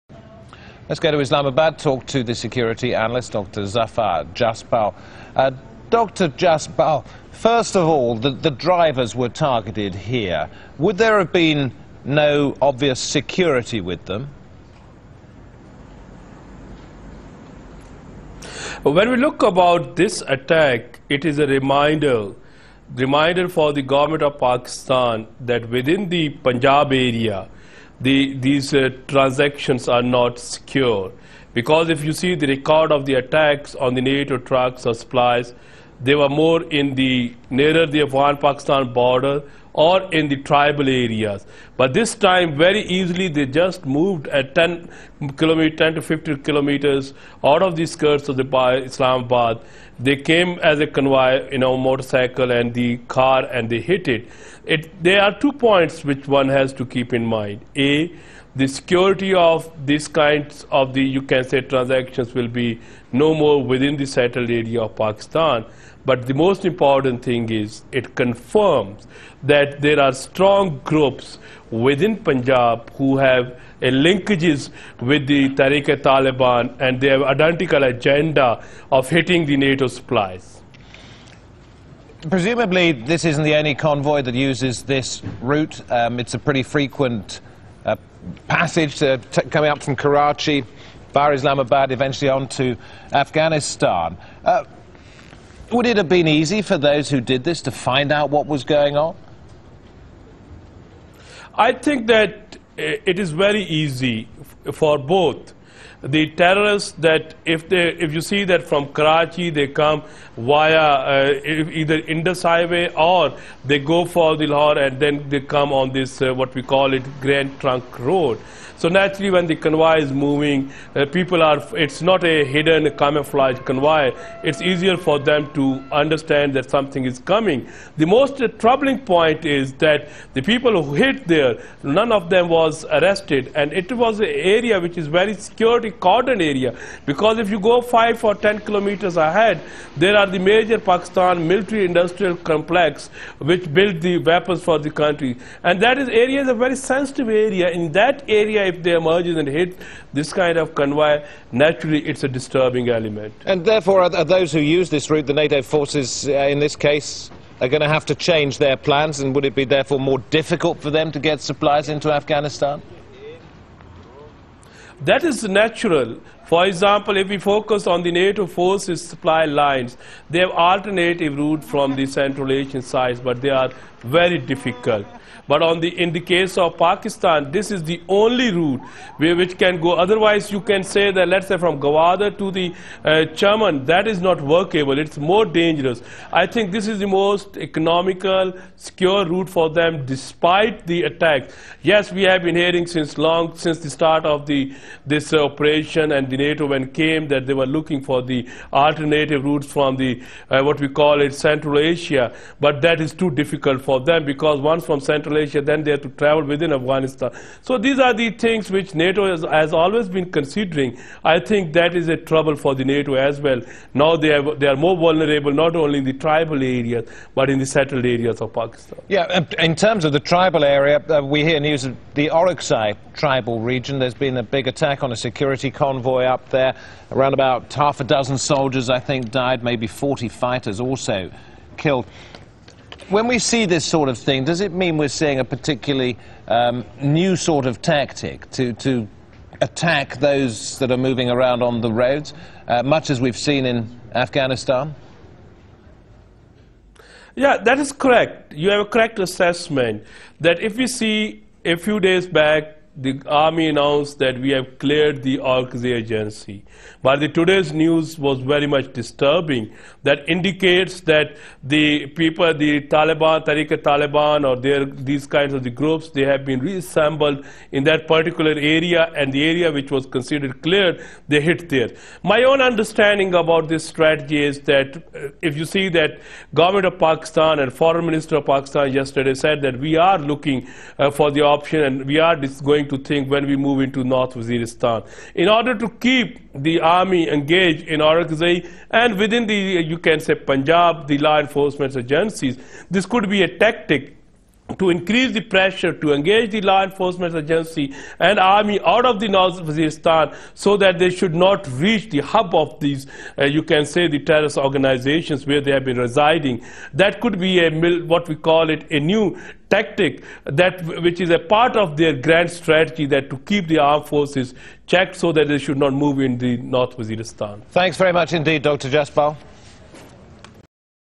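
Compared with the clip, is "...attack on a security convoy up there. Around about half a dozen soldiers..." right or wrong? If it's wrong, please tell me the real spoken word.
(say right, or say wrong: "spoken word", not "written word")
right.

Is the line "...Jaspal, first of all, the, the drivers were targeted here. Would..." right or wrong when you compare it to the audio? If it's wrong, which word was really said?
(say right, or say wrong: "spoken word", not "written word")
right.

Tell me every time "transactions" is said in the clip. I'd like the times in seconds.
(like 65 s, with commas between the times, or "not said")
29 s, 61 s.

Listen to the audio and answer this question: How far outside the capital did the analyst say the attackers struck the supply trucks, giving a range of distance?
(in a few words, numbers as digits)
10 to 50 kilometers.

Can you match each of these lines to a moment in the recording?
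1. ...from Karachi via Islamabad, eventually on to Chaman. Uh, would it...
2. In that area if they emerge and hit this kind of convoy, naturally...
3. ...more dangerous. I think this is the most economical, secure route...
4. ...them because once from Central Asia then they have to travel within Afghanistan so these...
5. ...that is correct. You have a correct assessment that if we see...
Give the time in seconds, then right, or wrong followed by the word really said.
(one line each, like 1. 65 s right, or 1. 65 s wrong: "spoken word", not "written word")
1. 89 s wrong: "Afghanistan", not "Chaman"
2. 147 s right
3. 185 s right
4. 204 s right
5. 247 s right.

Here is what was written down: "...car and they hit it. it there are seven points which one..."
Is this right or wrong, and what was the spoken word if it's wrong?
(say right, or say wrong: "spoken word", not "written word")
wrong: "two", not "seven".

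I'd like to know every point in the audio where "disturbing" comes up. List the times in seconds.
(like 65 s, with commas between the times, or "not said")
152 s, 258 s.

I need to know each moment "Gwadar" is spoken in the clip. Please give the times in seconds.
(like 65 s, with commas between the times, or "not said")
181 s.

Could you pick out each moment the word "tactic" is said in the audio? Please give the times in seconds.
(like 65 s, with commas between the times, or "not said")
237 s, 293 s, 309 s.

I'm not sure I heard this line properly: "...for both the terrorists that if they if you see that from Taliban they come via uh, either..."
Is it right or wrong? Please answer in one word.
wrong.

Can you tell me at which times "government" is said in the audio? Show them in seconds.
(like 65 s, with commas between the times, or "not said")
23 s, 276 s.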